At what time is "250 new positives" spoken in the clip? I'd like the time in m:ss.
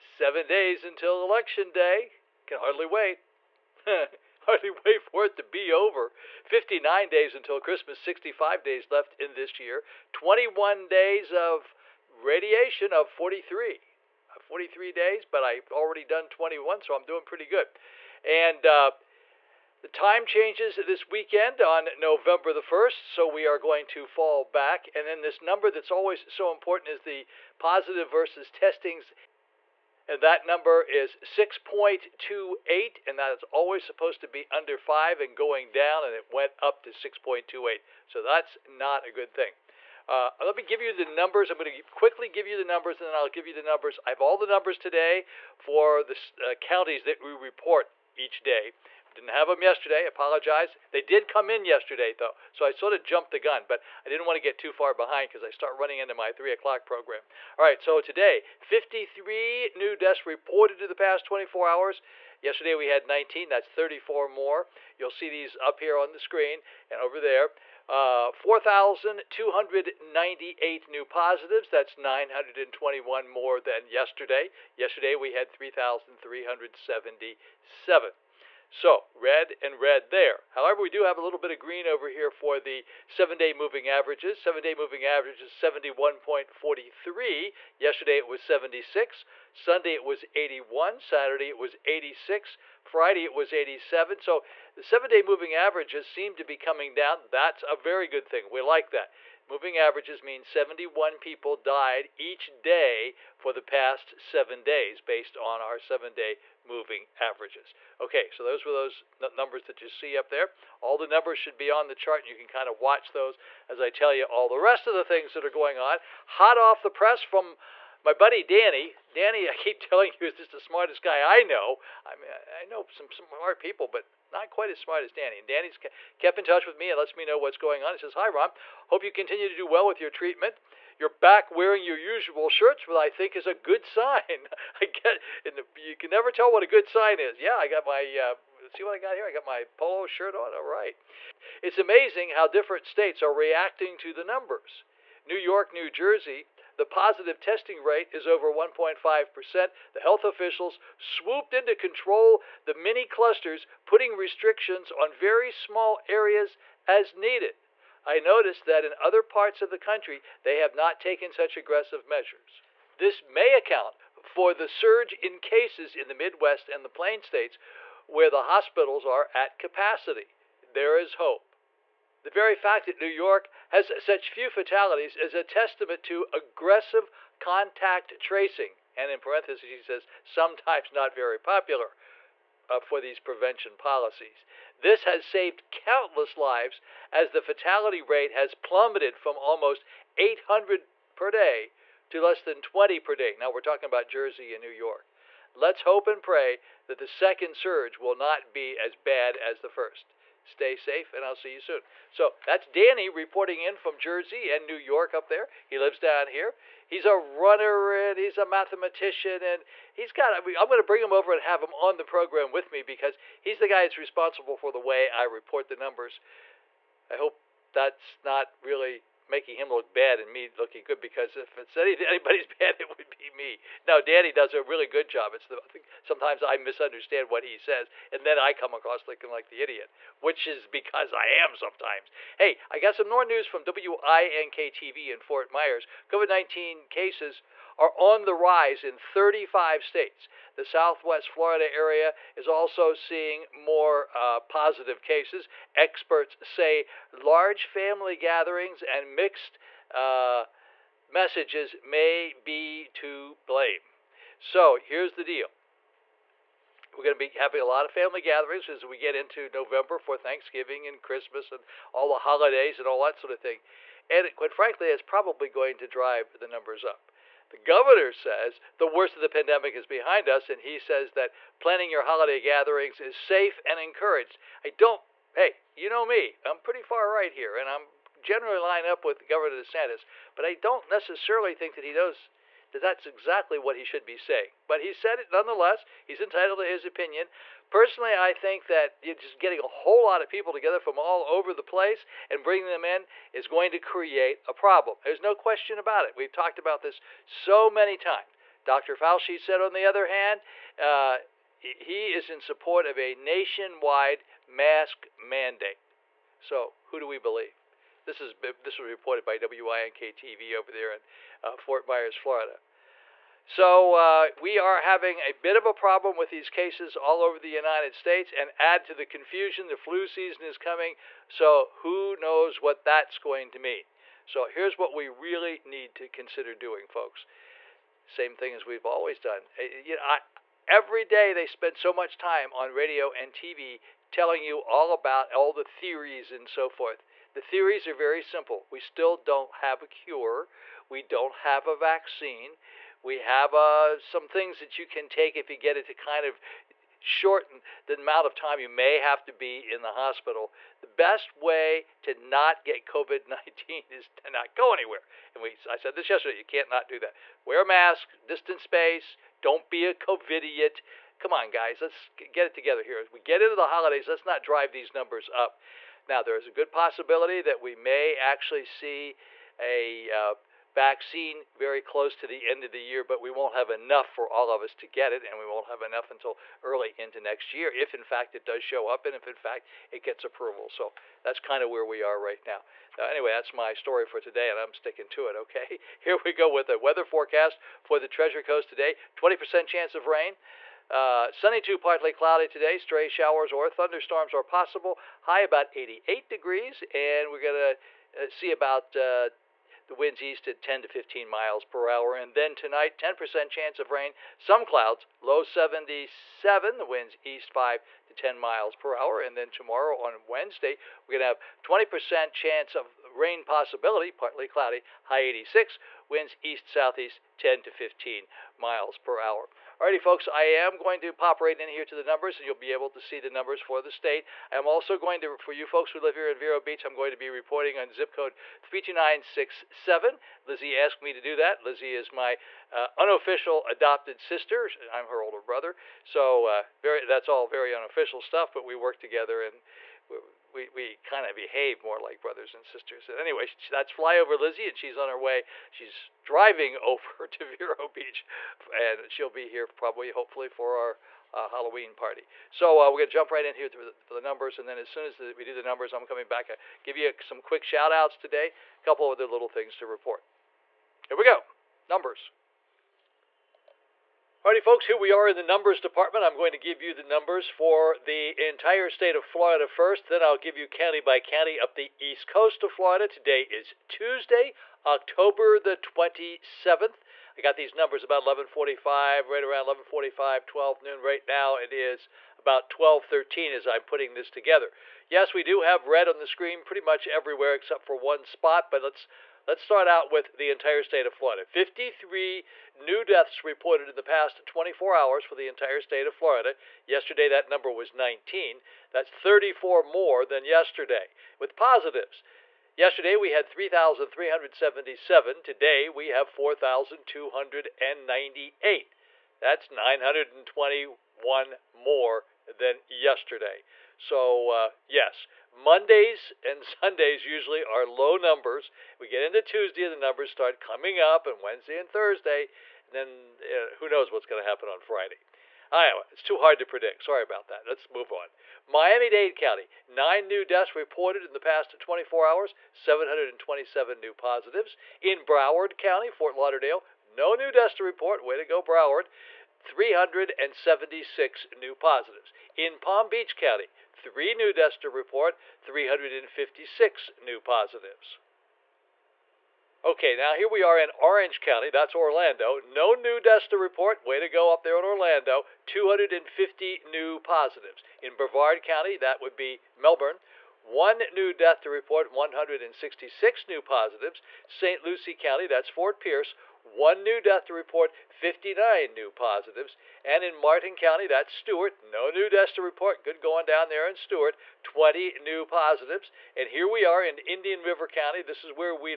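9:15.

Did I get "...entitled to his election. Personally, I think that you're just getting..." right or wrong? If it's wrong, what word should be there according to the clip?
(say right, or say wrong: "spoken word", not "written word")
wrong: "opinion", not "election".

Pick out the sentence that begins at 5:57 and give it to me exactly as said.
Wear a mask, distance space, don't be a COVIDiot.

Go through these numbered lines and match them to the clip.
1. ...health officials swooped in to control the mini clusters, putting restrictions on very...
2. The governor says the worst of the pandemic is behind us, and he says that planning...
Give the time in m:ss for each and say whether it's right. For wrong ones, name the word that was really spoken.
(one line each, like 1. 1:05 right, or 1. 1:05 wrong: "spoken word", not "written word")
1. 2:29 right
2. 4:27 right.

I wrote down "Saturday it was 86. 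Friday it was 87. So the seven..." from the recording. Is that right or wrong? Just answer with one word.
right.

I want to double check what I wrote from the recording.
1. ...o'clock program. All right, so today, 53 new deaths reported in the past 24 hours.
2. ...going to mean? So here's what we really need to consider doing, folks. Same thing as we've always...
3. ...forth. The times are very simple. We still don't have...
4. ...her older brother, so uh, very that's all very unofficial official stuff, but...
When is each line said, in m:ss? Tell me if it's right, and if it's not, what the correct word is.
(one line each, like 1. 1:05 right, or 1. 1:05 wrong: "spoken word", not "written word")
1. 0:56 right
2. 5:23 right
3. 5:36 wrong: "theories", not "times"
4. 7:15 right.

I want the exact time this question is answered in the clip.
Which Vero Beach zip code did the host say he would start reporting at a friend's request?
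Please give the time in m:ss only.
7:08.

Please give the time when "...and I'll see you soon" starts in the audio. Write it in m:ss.
3:21.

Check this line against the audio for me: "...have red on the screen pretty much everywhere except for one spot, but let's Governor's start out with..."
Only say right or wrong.
wrong.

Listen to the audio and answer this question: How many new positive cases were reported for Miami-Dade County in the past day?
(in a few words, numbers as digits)
727.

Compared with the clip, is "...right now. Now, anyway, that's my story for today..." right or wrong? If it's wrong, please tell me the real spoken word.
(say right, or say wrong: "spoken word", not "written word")
right.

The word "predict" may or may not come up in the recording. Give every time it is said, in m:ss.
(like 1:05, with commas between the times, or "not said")
8:46.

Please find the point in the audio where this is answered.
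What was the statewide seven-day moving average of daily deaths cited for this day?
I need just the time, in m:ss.
1:25.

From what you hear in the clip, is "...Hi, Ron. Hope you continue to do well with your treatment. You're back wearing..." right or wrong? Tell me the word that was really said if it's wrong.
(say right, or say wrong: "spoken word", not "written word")
right.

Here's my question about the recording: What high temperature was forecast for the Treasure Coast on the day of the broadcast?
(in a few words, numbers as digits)
88 degrees.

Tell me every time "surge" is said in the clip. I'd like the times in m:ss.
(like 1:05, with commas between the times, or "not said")
2:44, 3:17.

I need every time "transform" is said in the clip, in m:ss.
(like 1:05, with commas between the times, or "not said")
not said.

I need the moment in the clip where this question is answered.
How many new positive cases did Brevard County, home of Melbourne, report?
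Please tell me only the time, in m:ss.
9:22.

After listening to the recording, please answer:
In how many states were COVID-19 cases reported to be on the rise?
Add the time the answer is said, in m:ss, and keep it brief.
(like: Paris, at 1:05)
35, at 3:58.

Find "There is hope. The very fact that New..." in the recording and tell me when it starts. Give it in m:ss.
2:50.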